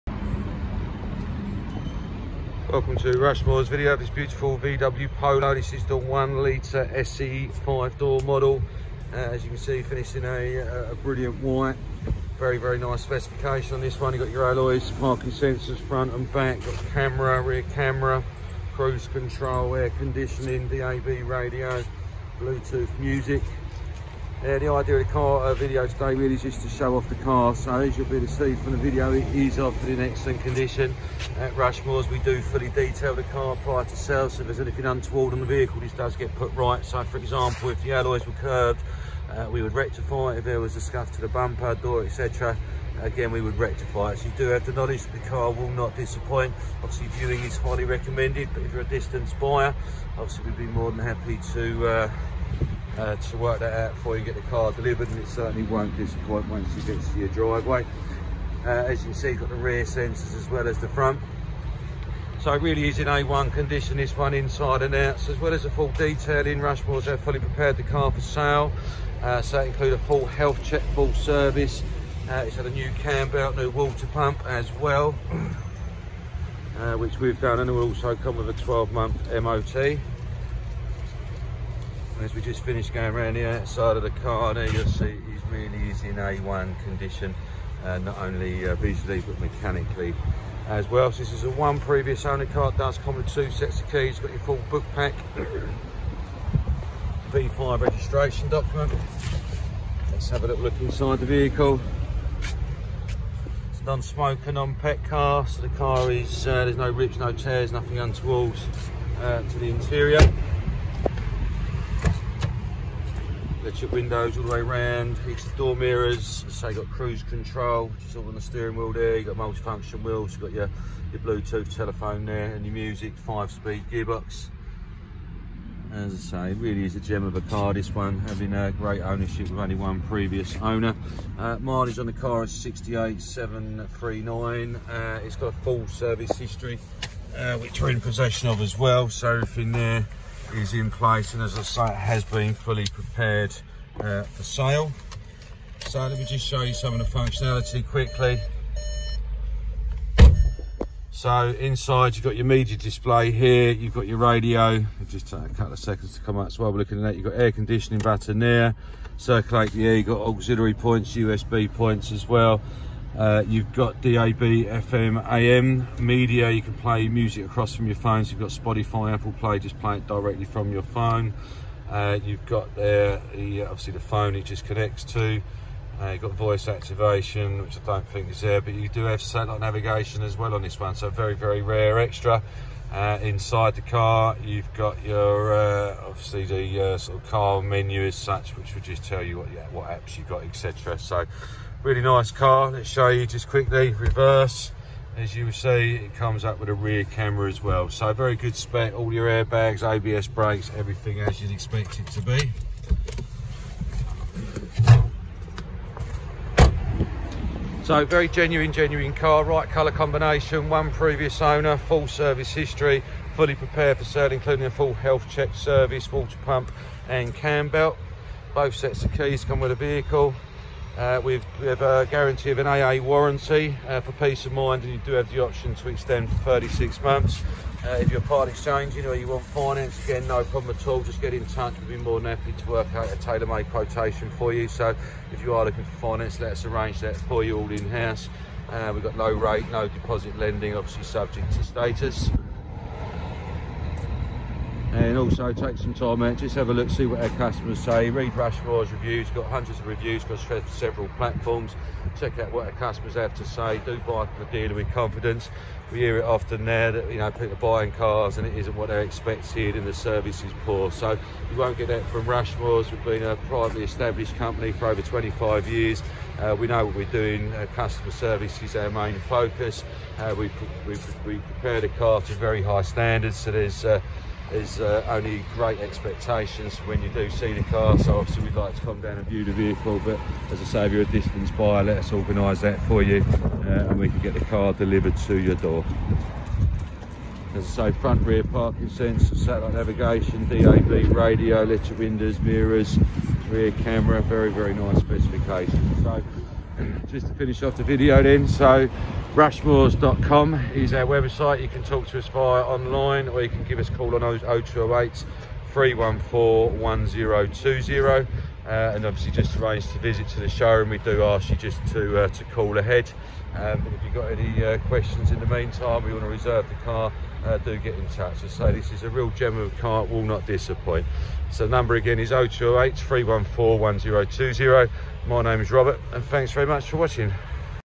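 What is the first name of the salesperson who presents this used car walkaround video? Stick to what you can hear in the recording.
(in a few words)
Robert.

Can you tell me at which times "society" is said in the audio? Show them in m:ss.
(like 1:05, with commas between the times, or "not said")
not said.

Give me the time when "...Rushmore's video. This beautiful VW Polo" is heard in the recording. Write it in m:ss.
0:03.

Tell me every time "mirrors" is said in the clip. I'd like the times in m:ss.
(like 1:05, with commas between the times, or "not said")
1:55, 4:52.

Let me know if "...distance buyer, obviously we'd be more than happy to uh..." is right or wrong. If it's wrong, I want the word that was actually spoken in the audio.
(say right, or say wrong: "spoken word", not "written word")
right.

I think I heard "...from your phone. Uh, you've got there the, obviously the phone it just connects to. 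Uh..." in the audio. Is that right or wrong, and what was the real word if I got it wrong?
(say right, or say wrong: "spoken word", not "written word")
right.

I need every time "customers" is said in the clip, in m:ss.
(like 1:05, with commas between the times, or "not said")
4:07, 4:12, 4:27.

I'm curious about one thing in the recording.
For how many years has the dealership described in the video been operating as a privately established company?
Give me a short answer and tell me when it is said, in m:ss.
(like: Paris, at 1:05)
over 25 years, at 4:24.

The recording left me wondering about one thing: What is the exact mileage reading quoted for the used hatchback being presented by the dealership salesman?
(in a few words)
68,739.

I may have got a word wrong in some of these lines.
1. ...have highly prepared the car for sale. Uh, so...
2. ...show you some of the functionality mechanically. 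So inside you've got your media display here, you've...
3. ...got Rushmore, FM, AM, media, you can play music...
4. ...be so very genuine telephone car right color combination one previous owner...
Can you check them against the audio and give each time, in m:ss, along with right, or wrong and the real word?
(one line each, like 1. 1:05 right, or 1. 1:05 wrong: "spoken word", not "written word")
1. 1:07 wrong: "fully", not "highly"
2. 2:26 wrong: "quickly", not "mechanically"
3. 2:43 wrong: "DAB", not "Rushmore"
4. 3:22 wrong: "genuine", not "telephone".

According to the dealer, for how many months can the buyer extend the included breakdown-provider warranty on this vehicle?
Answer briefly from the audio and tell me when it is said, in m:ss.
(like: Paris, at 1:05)
36 months, at 3:46.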